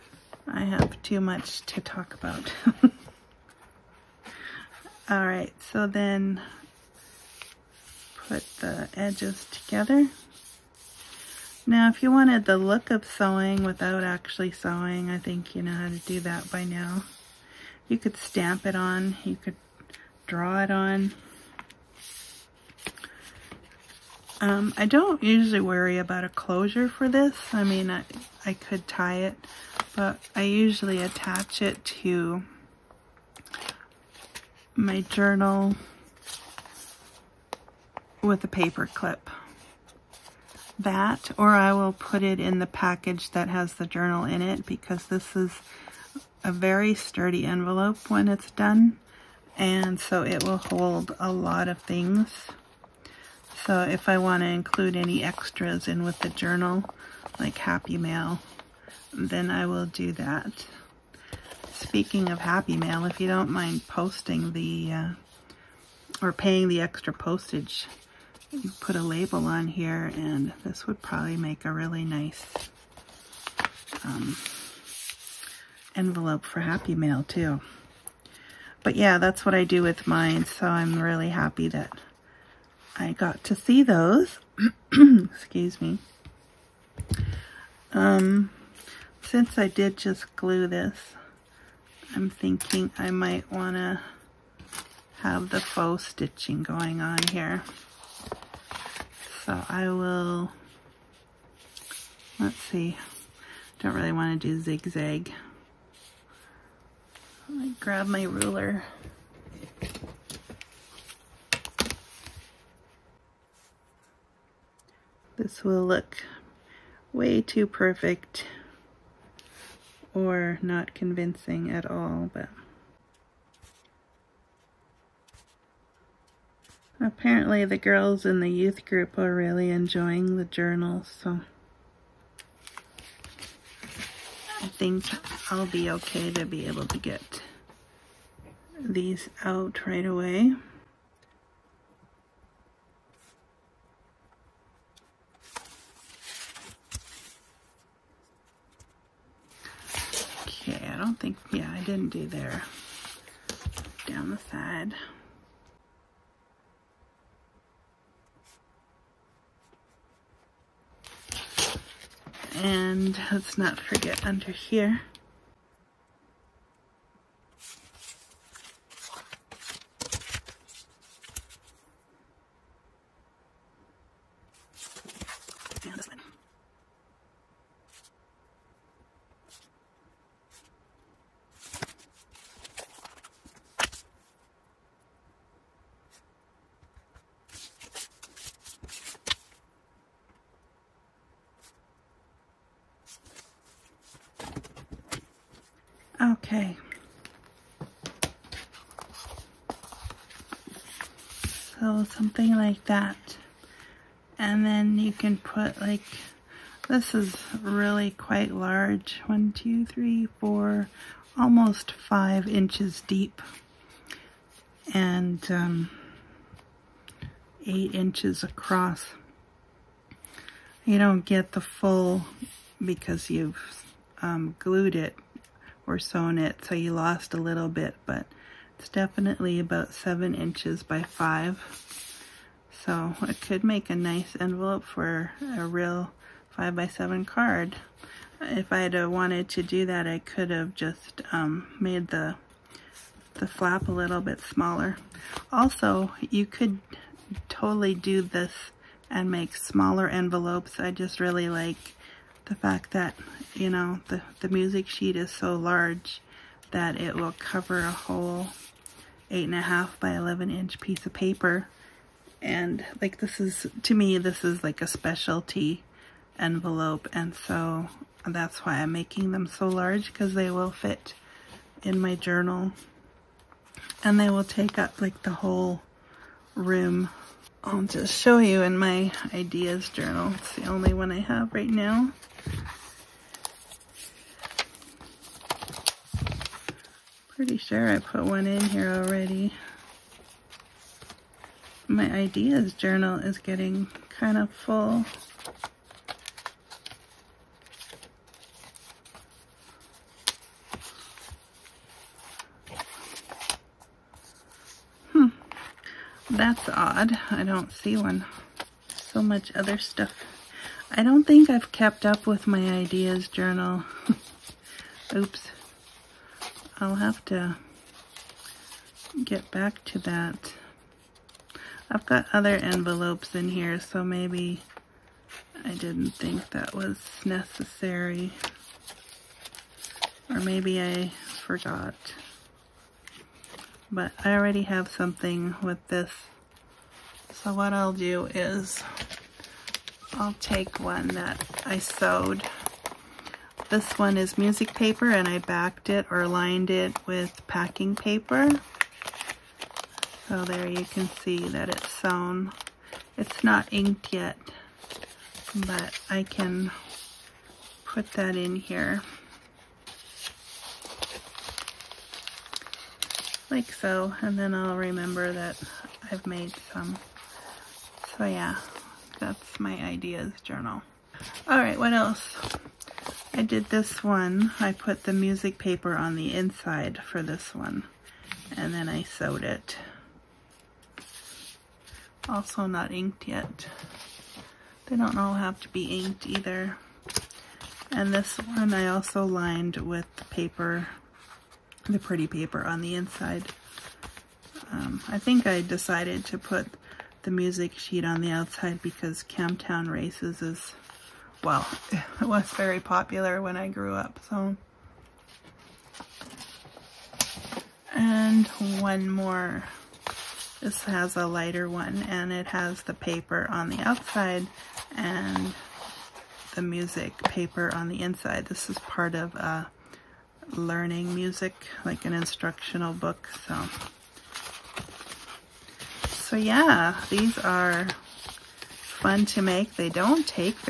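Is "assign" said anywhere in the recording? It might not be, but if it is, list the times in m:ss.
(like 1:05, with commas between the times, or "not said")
not said.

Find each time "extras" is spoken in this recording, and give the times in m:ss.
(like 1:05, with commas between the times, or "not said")
0:55, 1:06.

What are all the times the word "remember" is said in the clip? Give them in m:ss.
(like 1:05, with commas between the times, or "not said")
6:04.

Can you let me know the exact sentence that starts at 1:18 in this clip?
But yeah, that's what I do with mine, so I'm really happy that I got to see those.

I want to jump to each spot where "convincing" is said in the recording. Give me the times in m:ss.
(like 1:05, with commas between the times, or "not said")
2:00.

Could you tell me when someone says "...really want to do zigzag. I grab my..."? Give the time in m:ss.
1:43.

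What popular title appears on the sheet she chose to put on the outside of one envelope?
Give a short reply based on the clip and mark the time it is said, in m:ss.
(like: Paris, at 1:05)
Camptown Races, at 6:39.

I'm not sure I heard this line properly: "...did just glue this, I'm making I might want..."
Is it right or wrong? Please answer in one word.
wrong.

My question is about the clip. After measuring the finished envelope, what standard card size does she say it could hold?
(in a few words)
5 by 7.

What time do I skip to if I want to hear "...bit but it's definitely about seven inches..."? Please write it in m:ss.
3:47.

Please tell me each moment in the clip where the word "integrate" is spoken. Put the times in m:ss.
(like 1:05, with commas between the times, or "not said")
not said.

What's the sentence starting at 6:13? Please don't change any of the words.
I did this one, I put the music paper on the inside for this one, and then I sewed it.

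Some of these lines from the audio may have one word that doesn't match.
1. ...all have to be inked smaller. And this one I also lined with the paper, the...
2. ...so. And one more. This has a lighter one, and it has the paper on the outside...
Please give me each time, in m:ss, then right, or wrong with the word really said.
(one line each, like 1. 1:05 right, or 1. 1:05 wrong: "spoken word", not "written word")
1. 6:25 wrong: "either", not "smaller"
2. 6:44 right.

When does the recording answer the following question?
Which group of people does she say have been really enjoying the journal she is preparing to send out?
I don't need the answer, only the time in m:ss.
2:08.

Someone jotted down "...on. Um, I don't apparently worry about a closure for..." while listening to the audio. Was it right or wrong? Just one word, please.
wrong.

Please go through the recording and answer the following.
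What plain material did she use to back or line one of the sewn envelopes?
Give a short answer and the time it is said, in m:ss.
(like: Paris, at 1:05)
packing paper, at 5:47.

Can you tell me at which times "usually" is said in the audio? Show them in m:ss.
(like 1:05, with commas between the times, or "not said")
0:25, 0:30.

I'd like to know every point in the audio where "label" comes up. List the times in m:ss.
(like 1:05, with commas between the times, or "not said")
1:09.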